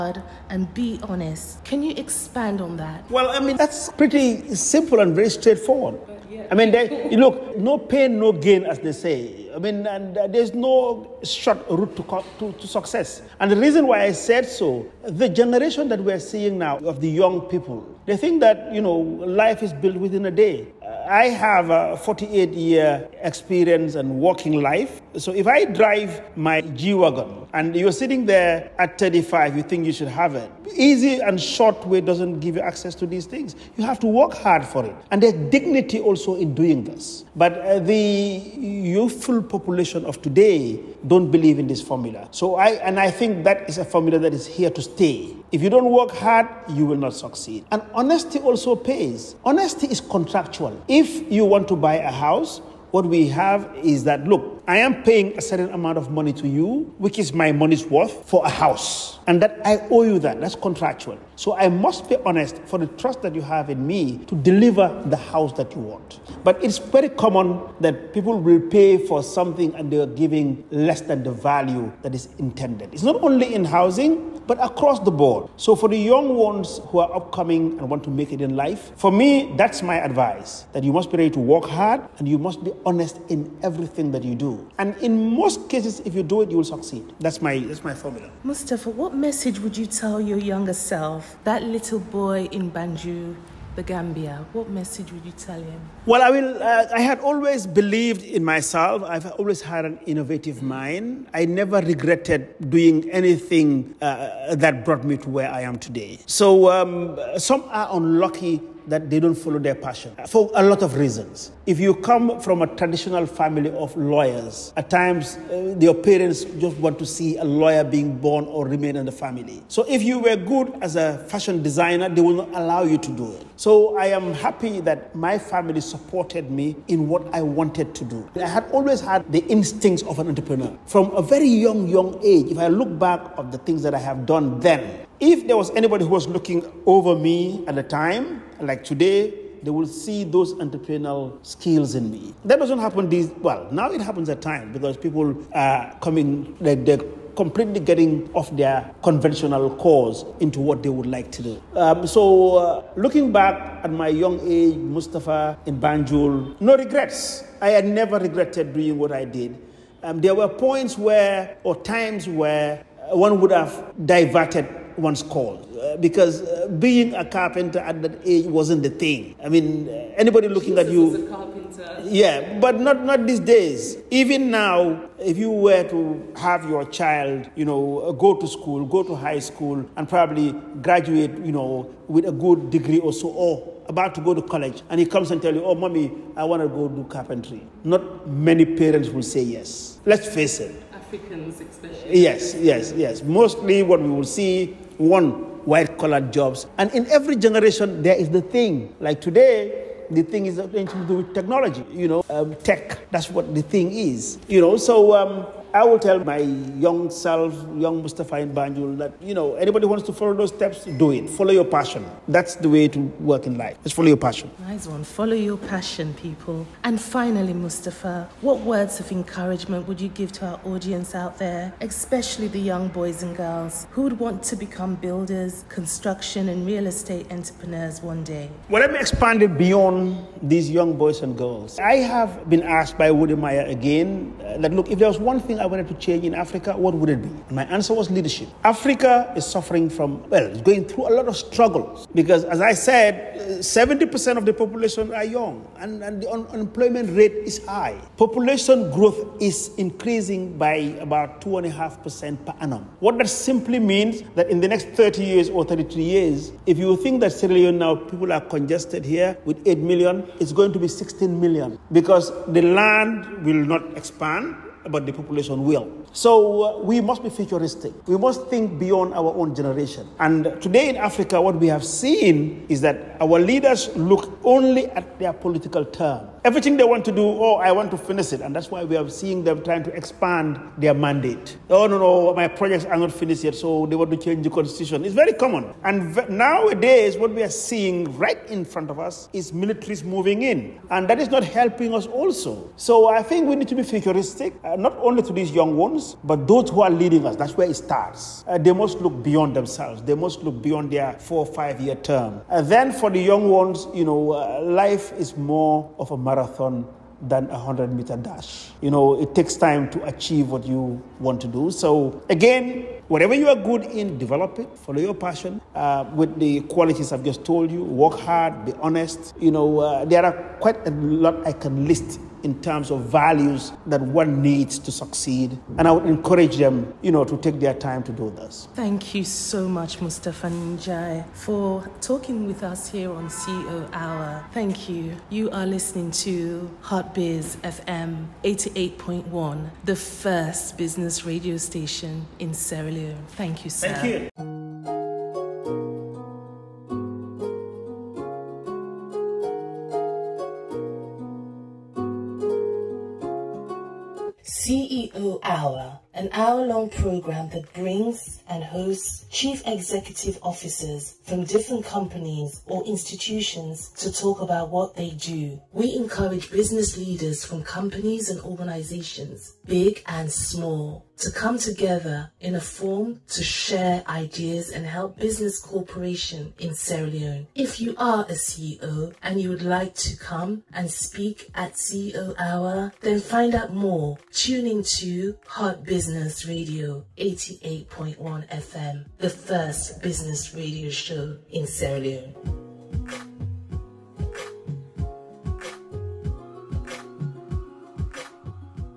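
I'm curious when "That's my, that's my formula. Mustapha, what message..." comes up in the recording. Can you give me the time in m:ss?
1:27.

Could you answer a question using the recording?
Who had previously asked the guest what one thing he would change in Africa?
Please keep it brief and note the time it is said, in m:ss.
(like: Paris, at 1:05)
Wode Maya, at 3:53.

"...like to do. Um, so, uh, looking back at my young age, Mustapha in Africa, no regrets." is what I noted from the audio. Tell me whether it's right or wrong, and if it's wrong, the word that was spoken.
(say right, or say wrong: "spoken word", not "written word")
wrong: "Banjul", not "Africa".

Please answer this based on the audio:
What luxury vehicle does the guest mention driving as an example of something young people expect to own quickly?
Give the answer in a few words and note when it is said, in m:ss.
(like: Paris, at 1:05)
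G Wagon, at 0:26.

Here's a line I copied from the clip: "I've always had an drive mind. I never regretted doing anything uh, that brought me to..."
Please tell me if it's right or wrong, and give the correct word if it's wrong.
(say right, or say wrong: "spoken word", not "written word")
wrong: "innovative", not "drive".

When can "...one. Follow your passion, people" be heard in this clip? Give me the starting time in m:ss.
3:34.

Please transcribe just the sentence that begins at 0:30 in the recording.
Easy and short way doesn't give you access to these things.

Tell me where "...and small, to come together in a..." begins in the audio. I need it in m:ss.
6:10.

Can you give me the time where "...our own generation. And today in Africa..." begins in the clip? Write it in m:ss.
4:29.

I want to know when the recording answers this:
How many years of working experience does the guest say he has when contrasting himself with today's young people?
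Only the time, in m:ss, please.
0:21.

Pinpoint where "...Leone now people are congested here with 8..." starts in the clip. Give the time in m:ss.
4:17.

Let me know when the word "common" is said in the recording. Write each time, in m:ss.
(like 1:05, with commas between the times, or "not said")
1:07, 4:45.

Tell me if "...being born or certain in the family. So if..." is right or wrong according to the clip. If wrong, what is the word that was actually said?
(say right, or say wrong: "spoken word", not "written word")
wrong: "remain", not "certain".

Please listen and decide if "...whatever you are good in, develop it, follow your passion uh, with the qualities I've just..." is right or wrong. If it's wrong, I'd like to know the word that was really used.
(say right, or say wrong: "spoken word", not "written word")
right.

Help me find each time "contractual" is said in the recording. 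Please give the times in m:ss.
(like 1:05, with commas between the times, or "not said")
0:50, 1:00.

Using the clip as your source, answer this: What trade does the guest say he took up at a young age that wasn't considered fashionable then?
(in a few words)
Carpenter.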